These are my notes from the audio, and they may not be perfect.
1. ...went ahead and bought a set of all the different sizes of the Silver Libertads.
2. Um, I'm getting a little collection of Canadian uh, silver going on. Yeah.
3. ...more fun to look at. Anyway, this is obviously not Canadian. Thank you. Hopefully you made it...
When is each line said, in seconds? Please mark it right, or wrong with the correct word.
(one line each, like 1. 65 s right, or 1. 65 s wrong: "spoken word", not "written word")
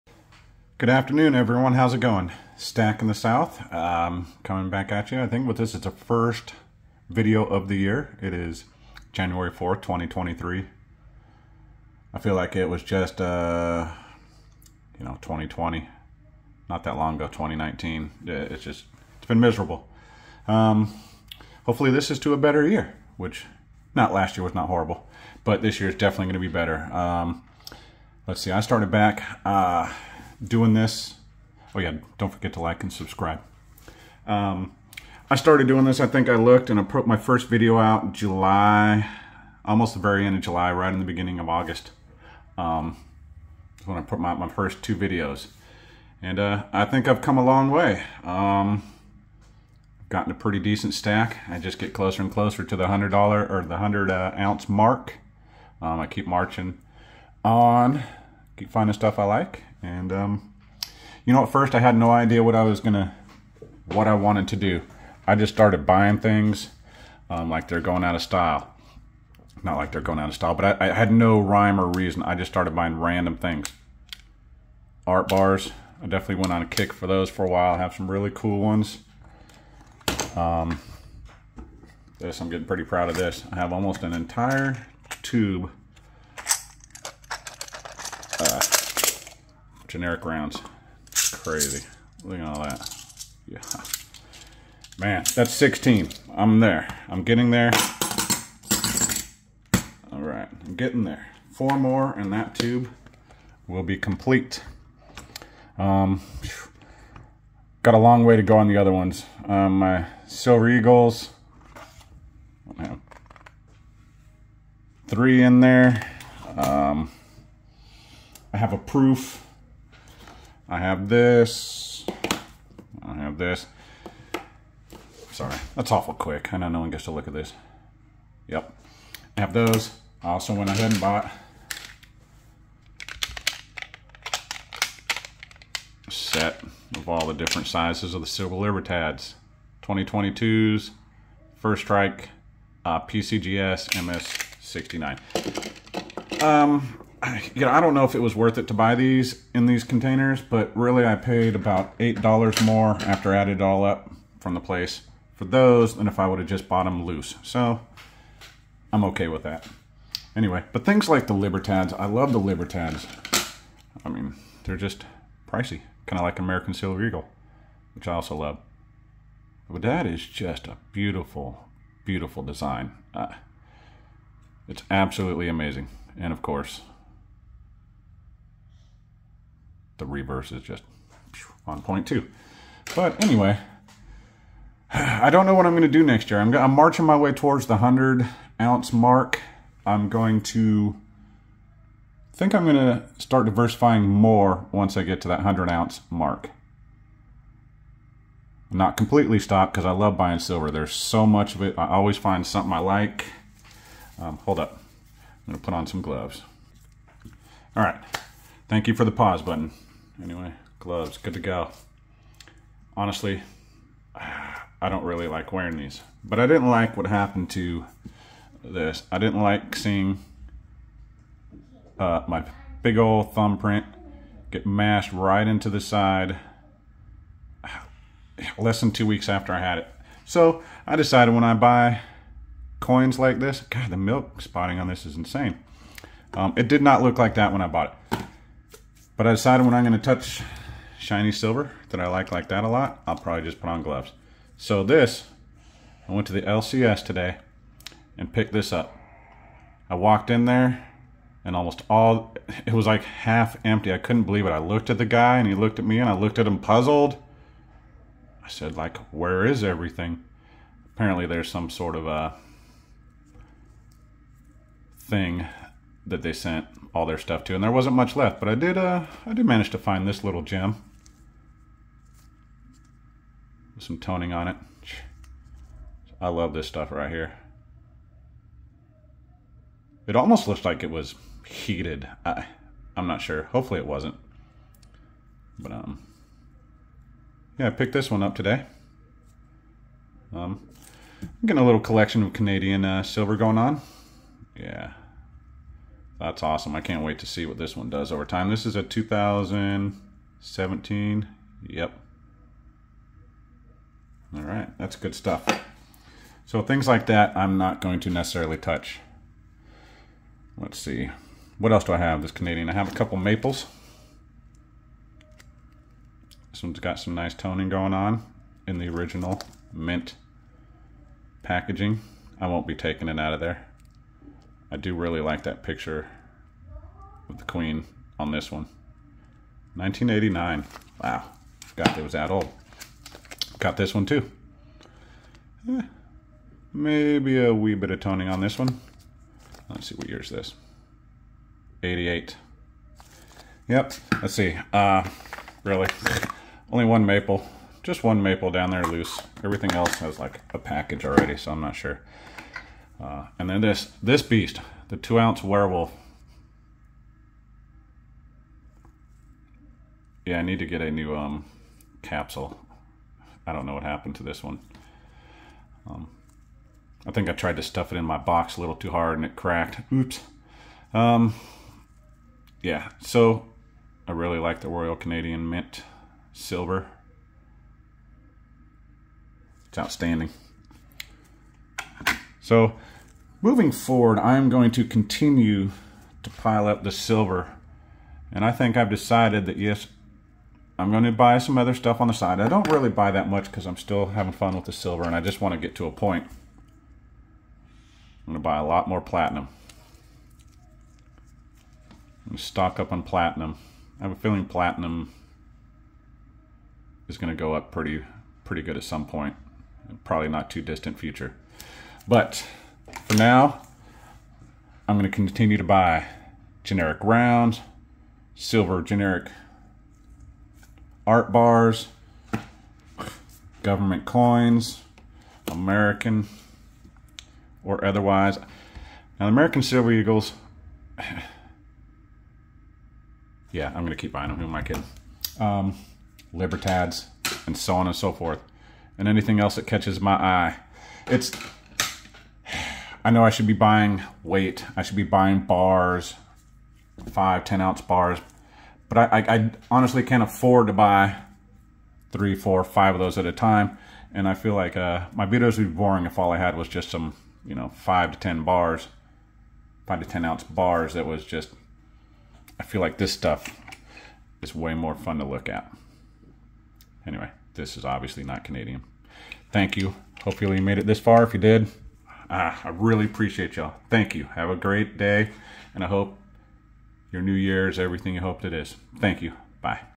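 1. 130 s right
2. 290 s right
3. 464 s right.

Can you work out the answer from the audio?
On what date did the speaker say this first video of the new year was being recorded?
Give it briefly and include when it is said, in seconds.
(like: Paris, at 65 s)
January 4th, 2023, at 9 s.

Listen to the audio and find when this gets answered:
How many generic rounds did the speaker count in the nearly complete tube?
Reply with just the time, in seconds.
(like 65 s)
95 s.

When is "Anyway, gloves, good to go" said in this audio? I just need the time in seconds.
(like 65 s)
210 s.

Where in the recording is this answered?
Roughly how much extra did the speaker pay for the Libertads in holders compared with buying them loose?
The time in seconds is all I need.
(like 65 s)
151 s.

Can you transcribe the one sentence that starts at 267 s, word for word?
And there wasn't much left, but I did uh, I did manage to find this little gem.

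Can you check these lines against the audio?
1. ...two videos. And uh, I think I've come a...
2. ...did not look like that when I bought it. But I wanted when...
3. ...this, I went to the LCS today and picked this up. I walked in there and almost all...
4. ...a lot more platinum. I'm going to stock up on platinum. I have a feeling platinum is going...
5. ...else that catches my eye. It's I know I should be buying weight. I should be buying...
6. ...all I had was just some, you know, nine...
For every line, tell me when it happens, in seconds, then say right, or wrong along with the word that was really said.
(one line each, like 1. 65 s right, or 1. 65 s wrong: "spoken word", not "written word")
1. 44 s right
2. 236 s wrong: "decided", not "wanted"
3. 244 s right
4. 398 s right
5. 439 s right
6. 456 s wrong: "five", not "nine".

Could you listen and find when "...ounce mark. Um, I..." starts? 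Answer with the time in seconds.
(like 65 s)
54 s.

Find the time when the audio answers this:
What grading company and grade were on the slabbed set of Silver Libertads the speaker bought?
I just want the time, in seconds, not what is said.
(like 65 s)
143 s.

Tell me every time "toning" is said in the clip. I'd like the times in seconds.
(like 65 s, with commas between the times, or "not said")
273 s, 317 s, 337 s.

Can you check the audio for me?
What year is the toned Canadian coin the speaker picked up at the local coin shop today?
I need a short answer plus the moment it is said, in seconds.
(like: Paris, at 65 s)
2017, at 298 s.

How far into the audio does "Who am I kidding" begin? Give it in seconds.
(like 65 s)
434 s.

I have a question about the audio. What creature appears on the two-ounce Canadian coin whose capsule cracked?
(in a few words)
werewolf.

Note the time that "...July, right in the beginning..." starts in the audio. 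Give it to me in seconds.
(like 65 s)
40 s.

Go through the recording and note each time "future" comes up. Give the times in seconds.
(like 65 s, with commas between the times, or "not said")
410 s.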